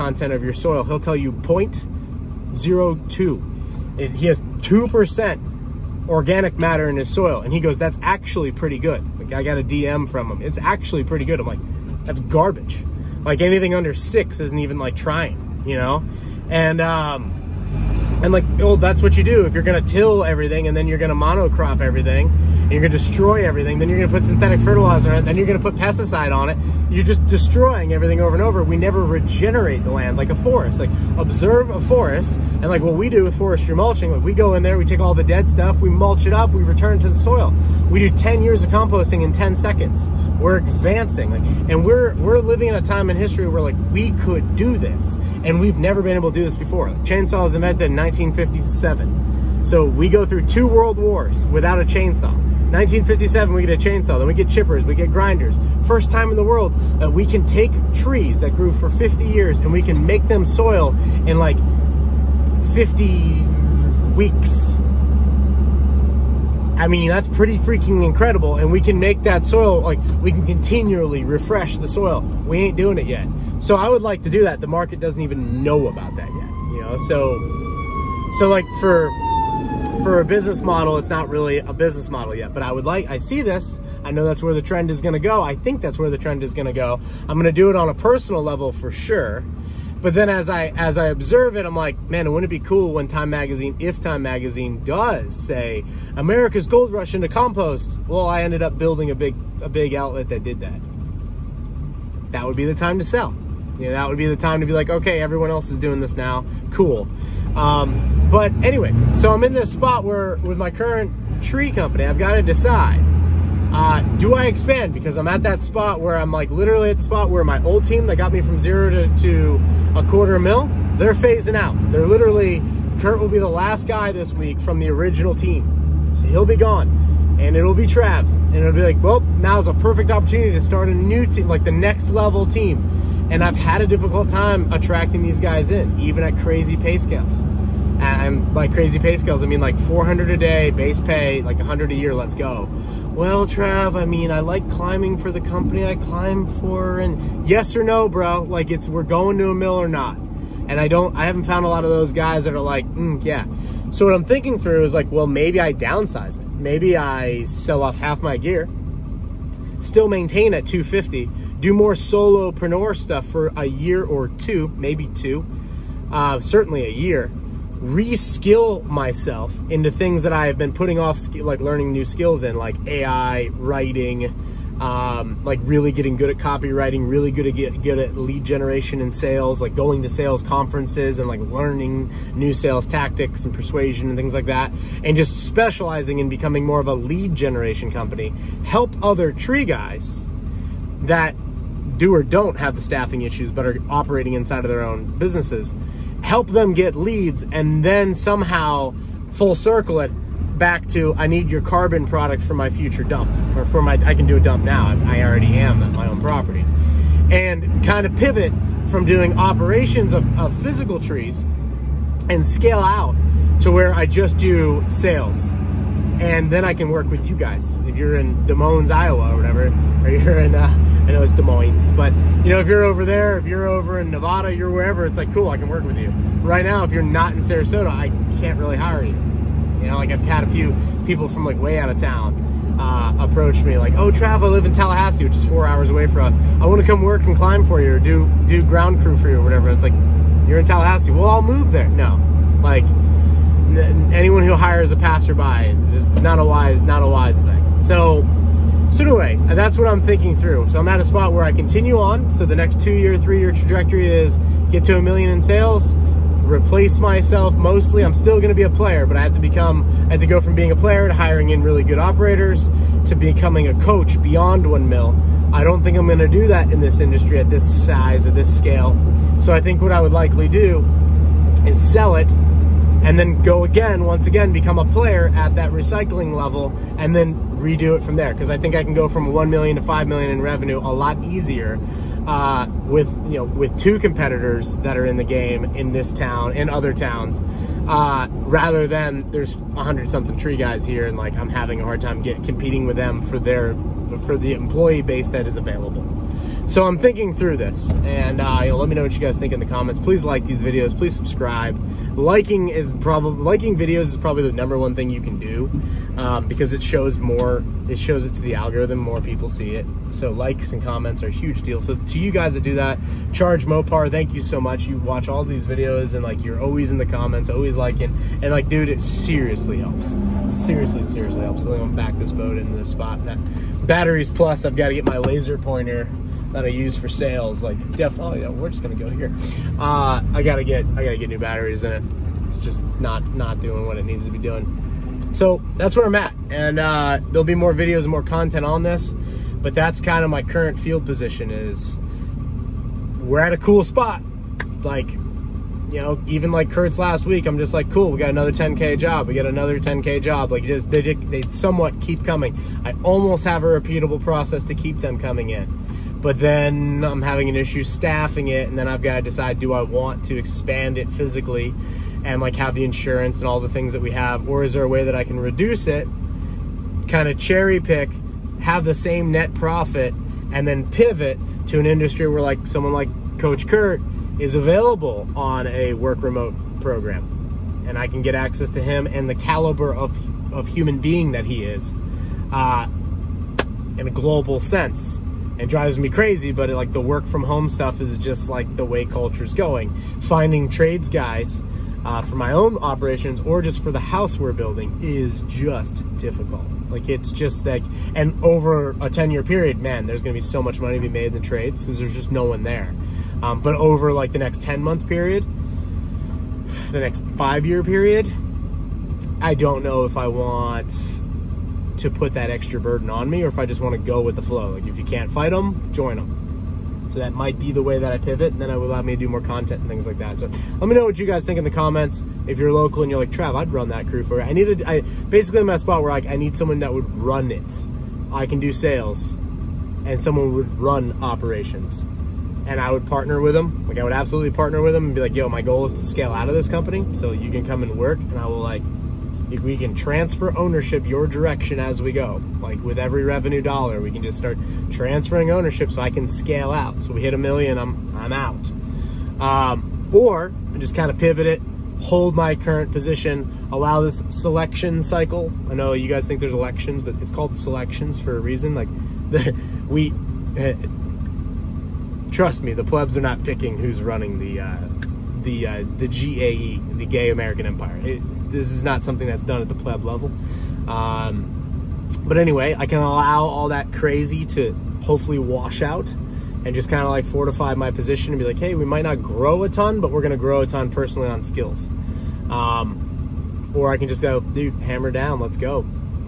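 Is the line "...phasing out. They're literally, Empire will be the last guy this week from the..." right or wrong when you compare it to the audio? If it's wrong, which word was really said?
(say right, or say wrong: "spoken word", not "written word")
wrong: "Kurt", not "Empire".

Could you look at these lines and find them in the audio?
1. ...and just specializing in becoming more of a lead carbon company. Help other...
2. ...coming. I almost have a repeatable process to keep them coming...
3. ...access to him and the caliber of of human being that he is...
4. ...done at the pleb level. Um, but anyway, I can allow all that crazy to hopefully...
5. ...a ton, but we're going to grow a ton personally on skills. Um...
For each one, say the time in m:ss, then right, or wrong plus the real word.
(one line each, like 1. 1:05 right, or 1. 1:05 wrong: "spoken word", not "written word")
1. 3:05 wrong: "generation", not "carbon"
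2. 5:52 right
3. 6:18 right
4. 7:49 right
5. 7:59 right.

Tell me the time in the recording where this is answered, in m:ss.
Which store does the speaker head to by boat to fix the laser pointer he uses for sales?
5:23.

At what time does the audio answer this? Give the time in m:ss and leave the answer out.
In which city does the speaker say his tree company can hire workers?
3:47.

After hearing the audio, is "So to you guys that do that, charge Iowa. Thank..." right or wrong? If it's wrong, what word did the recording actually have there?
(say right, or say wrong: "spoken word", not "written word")
wrong: "Mopar", not "Iowa".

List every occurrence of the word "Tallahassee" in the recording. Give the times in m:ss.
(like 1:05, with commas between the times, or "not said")
3:54, 4:00.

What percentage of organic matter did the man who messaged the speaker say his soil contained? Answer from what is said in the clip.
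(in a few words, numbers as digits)
2%.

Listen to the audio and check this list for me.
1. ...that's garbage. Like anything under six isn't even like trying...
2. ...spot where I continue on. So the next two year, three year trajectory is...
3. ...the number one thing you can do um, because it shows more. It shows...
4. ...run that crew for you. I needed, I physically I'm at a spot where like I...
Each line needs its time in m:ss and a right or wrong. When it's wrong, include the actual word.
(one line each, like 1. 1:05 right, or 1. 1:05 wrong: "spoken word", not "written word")
1. 0:12 right
2. 4:11 right
3. 5:04 right
4. 7:03 wrong: "basically", not "physically".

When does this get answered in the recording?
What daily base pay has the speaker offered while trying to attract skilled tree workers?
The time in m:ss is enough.
2:19.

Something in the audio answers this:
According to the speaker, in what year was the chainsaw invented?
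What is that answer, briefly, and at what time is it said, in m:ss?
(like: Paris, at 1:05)
1957, at 0:47.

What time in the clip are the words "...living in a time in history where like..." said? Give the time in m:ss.
0:42.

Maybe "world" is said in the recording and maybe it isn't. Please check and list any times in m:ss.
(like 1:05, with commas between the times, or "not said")
0:50, 0:56.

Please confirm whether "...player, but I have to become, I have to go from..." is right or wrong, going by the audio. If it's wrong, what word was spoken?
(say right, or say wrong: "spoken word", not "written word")
right.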